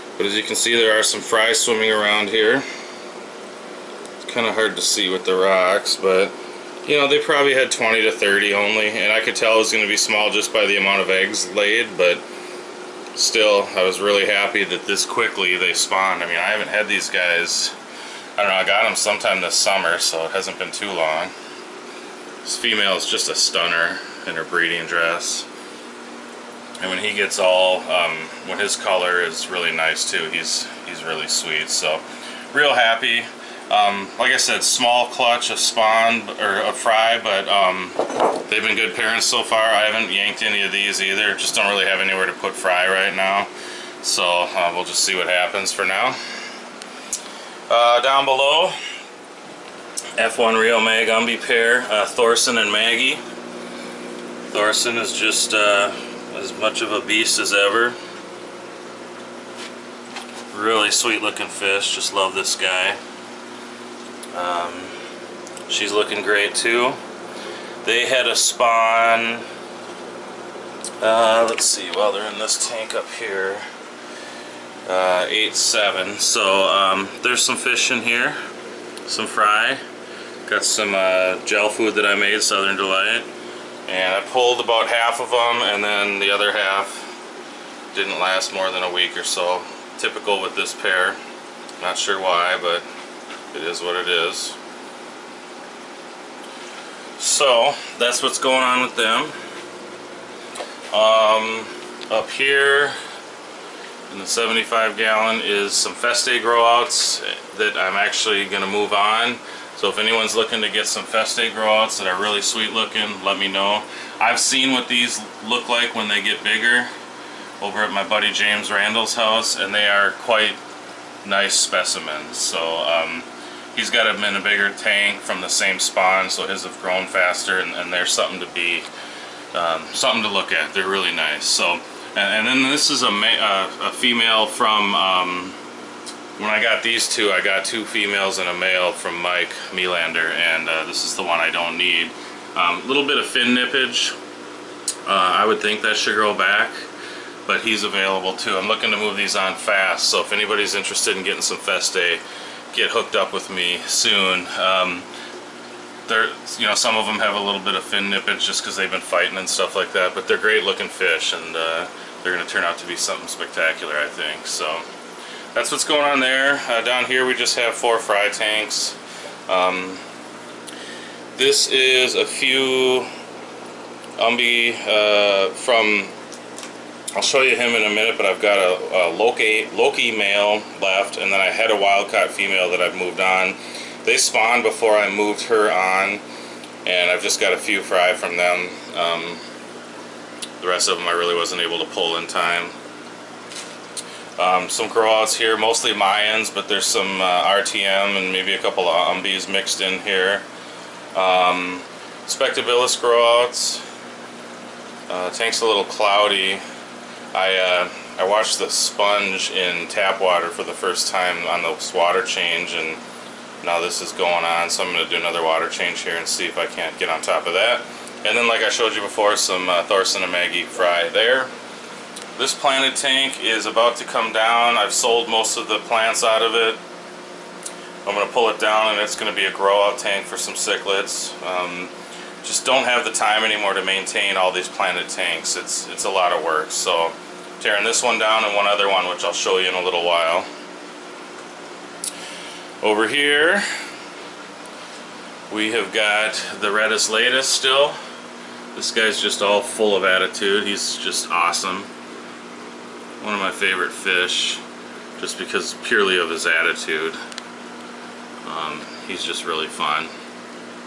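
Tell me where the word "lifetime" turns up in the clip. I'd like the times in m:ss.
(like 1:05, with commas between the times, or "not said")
not said.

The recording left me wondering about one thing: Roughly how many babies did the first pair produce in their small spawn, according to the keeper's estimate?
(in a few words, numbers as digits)
20 to 30.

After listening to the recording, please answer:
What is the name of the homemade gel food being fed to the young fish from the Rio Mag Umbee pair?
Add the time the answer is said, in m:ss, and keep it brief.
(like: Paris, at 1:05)
Southern Delight, at 1:22.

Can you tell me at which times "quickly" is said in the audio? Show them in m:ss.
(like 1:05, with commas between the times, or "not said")
0:15.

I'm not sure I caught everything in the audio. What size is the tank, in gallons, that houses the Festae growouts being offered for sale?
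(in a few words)
75.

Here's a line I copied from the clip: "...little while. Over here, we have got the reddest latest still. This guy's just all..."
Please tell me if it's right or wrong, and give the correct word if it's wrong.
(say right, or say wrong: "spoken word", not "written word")
right.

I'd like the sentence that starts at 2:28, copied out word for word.
I'm looking to move these on fast, so if anybody's interested in getting some Festae get hooked up with me soon.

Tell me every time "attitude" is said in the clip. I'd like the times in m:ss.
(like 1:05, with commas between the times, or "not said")
4:10, 4:16.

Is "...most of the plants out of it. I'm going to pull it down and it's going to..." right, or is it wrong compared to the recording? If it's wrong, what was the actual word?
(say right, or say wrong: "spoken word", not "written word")
right.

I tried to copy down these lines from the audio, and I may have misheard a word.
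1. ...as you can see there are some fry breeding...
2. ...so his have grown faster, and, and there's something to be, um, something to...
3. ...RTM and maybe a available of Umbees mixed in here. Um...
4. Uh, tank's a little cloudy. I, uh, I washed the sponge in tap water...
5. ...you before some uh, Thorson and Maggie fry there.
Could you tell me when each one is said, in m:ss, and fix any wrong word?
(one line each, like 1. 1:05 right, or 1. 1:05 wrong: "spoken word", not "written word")
1. 0:00 wrong: "swimming", not "breeding"
2. 2:06 right
3. 3:17 wrong: "couple", not "available"
4. 3:25 right
5. 3:38 right.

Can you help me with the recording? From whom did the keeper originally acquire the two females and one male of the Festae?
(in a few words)
Mike Melander.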